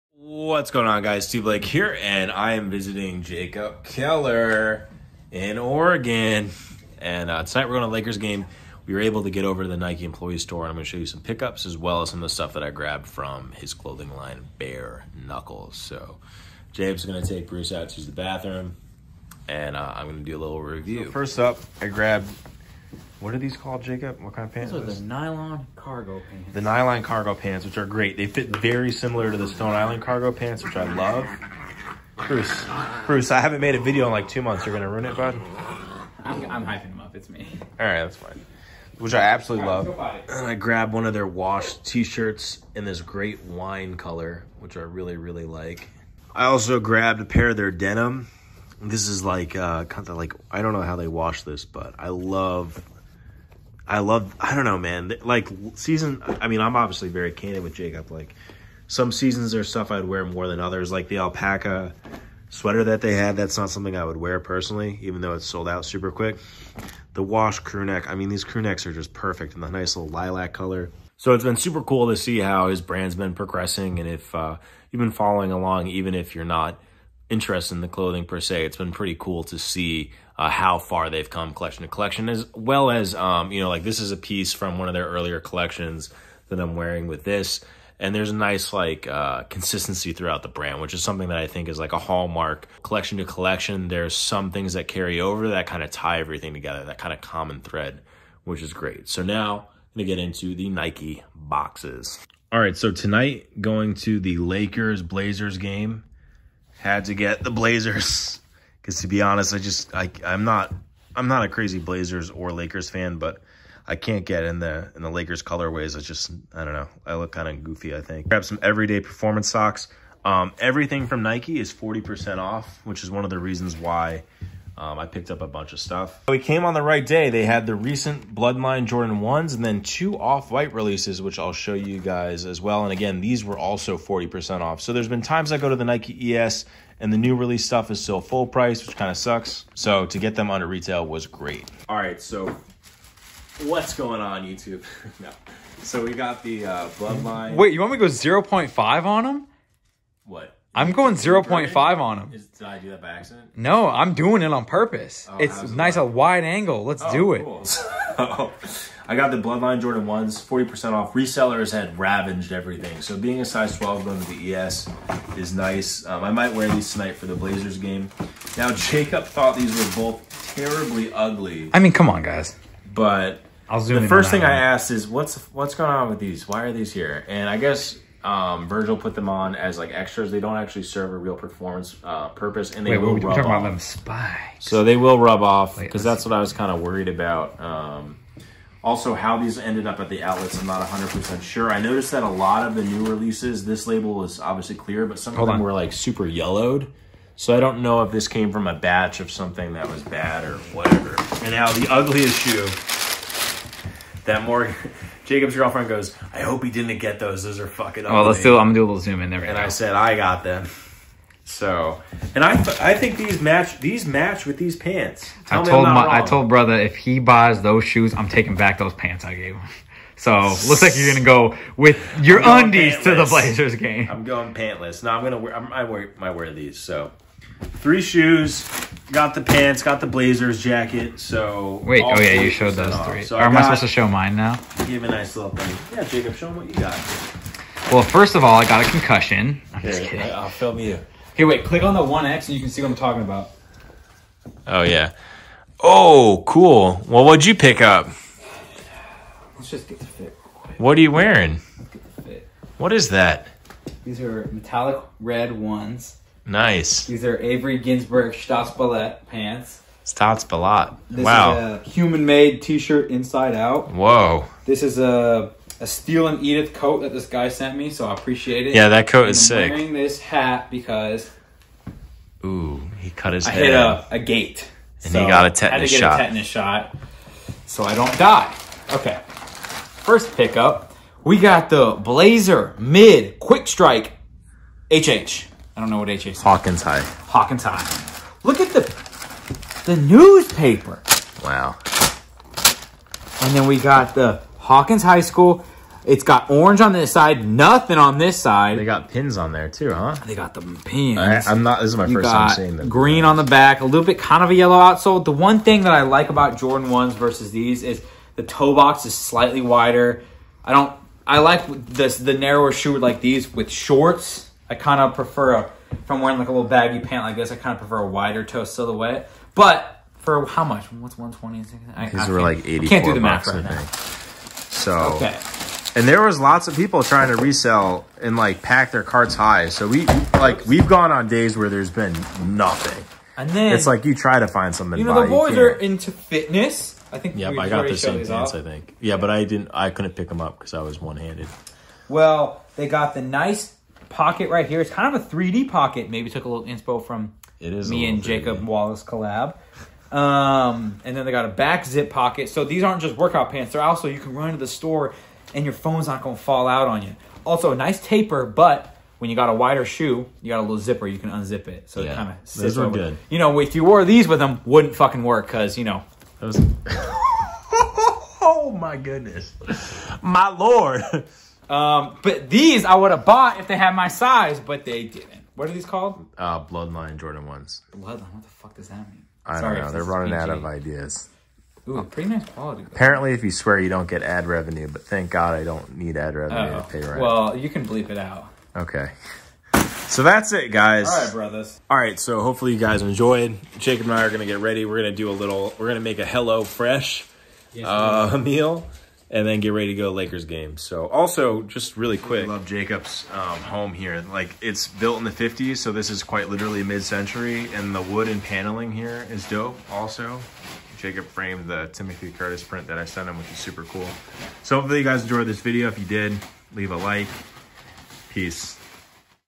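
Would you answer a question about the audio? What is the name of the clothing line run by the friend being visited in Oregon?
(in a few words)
Bare Knuckles.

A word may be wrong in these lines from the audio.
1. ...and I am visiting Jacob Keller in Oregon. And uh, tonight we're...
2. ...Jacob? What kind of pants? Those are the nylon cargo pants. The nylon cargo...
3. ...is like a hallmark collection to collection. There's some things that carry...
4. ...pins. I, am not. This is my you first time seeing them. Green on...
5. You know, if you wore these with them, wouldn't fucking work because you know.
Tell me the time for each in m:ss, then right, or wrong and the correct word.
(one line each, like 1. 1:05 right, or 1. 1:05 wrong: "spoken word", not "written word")
1. 0:02 right
2. 0:23 right
3. 1:31 right
4. 5:00 right
5. 6:03 right.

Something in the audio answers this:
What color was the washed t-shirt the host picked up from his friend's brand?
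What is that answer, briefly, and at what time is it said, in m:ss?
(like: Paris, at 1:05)
Wine, at 0:43.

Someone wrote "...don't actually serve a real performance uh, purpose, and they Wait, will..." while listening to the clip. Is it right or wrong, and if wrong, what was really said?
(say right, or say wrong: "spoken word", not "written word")
right.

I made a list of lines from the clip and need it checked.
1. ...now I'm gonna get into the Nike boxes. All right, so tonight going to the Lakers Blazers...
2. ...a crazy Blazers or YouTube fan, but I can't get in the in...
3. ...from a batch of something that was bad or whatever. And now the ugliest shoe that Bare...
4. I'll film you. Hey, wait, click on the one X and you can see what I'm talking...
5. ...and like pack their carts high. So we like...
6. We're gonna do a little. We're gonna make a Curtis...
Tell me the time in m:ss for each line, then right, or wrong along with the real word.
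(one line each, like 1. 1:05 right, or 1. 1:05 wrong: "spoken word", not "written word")
1. 1:39 right
2. 1:51 wrong: "Lakers", not "YouTube"
3. 3:18 wrong: "Morgan", not "Bare"
4. 4:00 right
5. 5:28 right
6. 6:34 wrong: "Hello", not "Curtis".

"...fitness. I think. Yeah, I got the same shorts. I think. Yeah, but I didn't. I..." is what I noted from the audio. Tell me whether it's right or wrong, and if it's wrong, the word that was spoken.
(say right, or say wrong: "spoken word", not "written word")
wrong: "pants", not "shorts".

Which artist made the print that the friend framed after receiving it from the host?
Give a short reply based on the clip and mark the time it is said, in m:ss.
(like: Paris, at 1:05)
Timothy Curtis, at 6:51.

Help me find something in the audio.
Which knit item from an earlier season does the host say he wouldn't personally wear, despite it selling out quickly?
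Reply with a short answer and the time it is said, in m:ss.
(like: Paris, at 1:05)
Alpaca sweater, at 1:01.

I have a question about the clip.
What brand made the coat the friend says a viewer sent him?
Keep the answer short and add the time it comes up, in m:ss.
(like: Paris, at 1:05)
Steel and Edith, at 4:25.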